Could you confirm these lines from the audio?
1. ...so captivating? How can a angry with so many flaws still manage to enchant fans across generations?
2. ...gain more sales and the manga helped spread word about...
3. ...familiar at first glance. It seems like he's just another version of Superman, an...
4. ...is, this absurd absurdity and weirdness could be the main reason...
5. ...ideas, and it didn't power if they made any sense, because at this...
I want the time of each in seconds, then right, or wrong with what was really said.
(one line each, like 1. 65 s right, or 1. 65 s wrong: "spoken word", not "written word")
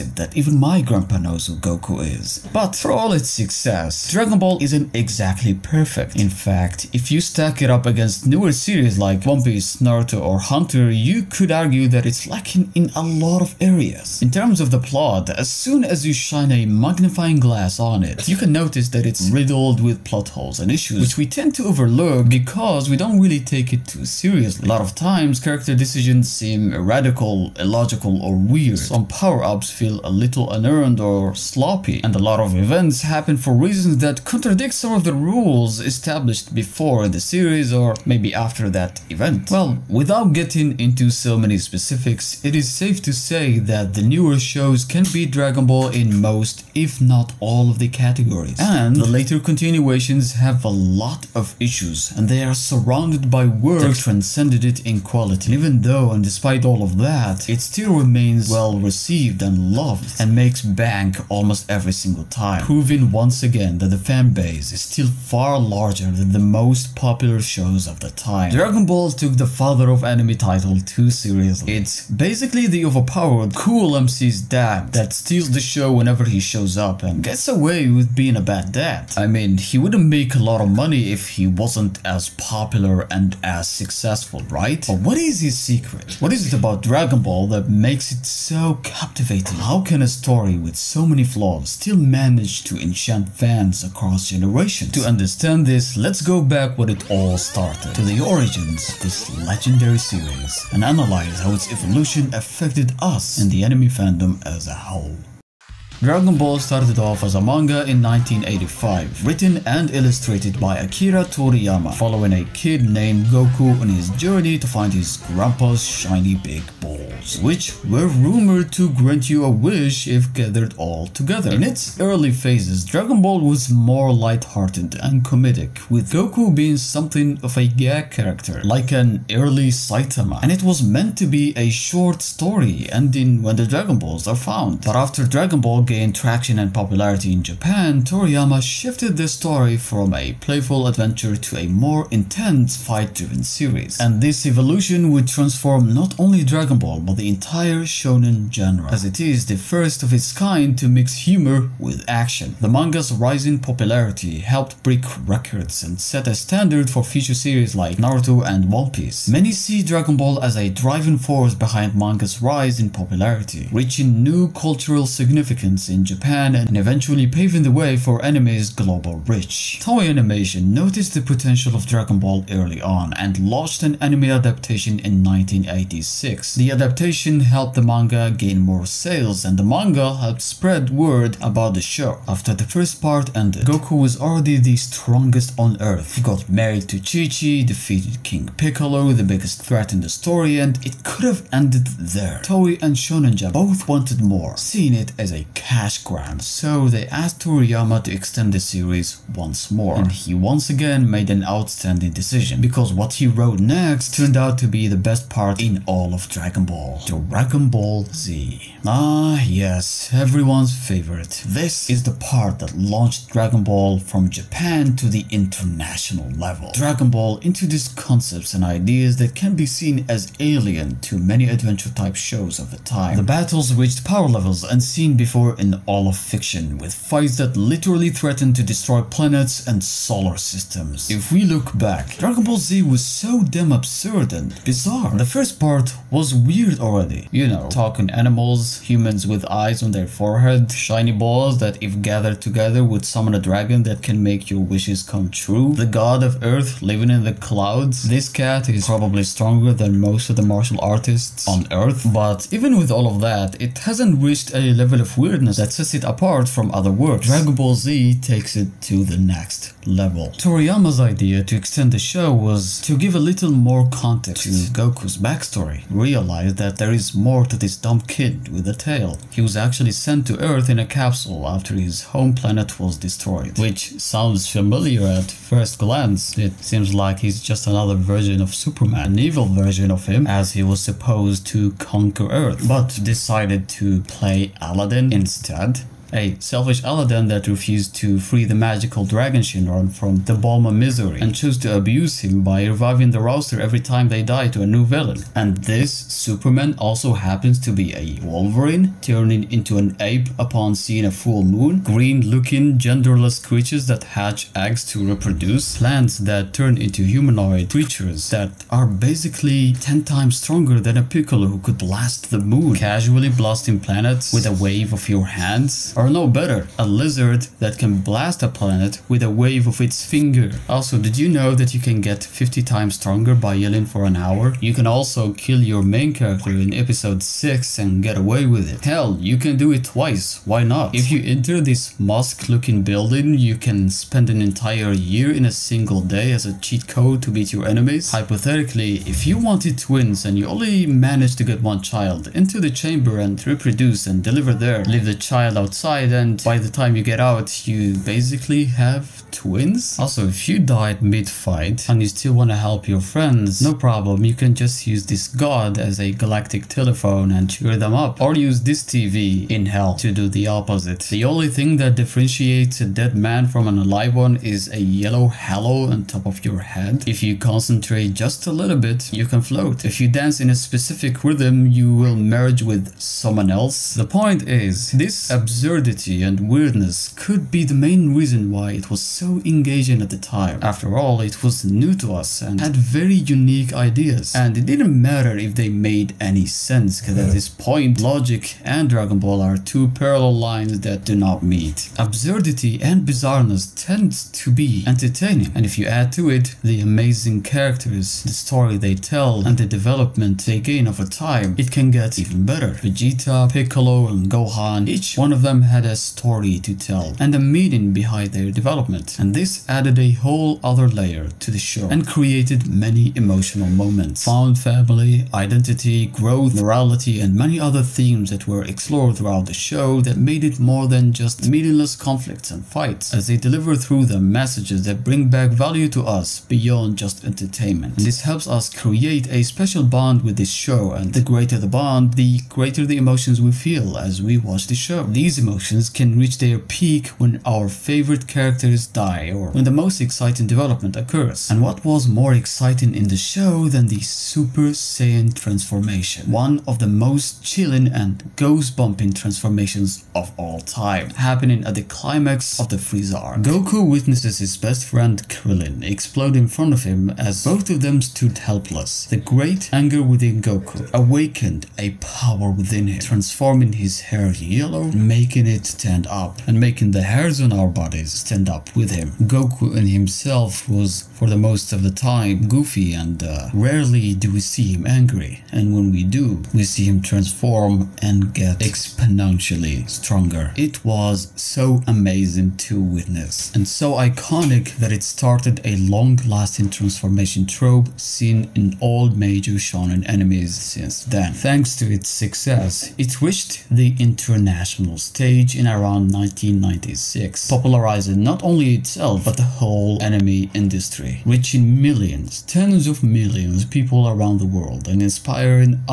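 1. 88 s wrong: "story", not "angry"
2. 178 s right
3. 274 s right
4. 374 s right
5. 383 s wrong: "matter", not "power".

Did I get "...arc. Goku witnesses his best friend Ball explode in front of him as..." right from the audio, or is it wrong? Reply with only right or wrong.
wrong.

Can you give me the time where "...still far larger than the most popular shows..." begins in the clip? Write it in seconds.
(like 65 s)
64 s.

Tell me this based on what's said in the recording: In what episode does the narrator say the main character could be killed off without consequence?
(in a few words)
episode 6.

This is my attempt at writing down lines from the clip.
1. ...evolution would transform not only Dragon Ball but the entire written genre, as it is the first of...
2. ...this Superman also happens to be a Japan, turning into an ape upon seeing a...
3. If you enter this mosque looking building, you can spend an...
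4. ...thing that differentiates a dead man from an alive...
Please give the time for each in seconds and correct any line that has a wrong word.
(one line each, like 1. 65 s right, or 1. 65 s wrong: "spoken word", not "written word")
1. 144 s wrong: "shonen", not "written"
2. 295 s wrong: "Wolverine", not "Japan"
3. 330 s right
4. 361 s right.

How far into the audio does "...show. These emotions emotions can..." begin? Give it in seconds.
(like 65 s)
434 s.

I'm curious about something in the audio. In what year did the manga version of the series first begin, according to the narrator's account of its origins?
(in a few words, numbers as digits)
1985.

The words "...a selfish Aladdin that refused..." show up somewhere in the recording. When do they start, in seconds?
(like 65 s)
286 s.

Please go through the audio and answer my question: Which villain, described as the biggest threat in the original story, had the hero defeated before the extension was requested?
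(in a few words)
King Piccolo.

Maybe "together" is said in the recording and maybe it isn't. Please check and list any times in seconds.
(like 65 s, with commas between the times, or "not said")
121 s, 242 s.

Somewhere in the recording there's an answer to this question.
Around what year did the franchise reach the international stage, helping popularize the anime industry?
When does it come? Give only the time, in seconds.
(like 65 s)
496 s.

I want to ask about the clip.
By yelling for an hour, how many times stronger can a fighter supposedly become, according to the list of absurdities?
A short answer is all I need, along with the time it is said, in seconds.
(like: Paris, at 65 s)
50 times, at 322 s.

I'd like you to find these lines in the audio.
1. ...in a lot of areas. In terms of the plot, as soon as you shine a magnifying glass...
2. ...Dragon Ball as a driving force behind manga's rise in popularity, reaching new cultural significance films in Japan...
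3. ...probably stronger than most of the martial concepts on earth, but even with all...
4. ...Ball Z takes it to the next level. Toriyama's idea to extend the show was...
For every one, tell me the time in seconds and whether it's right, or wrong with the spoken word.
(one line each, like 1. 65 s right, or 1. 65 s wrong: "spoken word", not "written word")
1. 12 s right
2. 159 s right
3. 248 s wrong: "artists", not "concepts"
4. 257 s right.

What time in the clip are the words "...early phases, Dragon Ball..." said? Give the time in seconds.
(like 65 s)
121 s.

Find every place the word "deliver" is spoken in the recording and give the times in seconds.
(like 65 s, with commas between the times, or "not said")
344 s, 423 s.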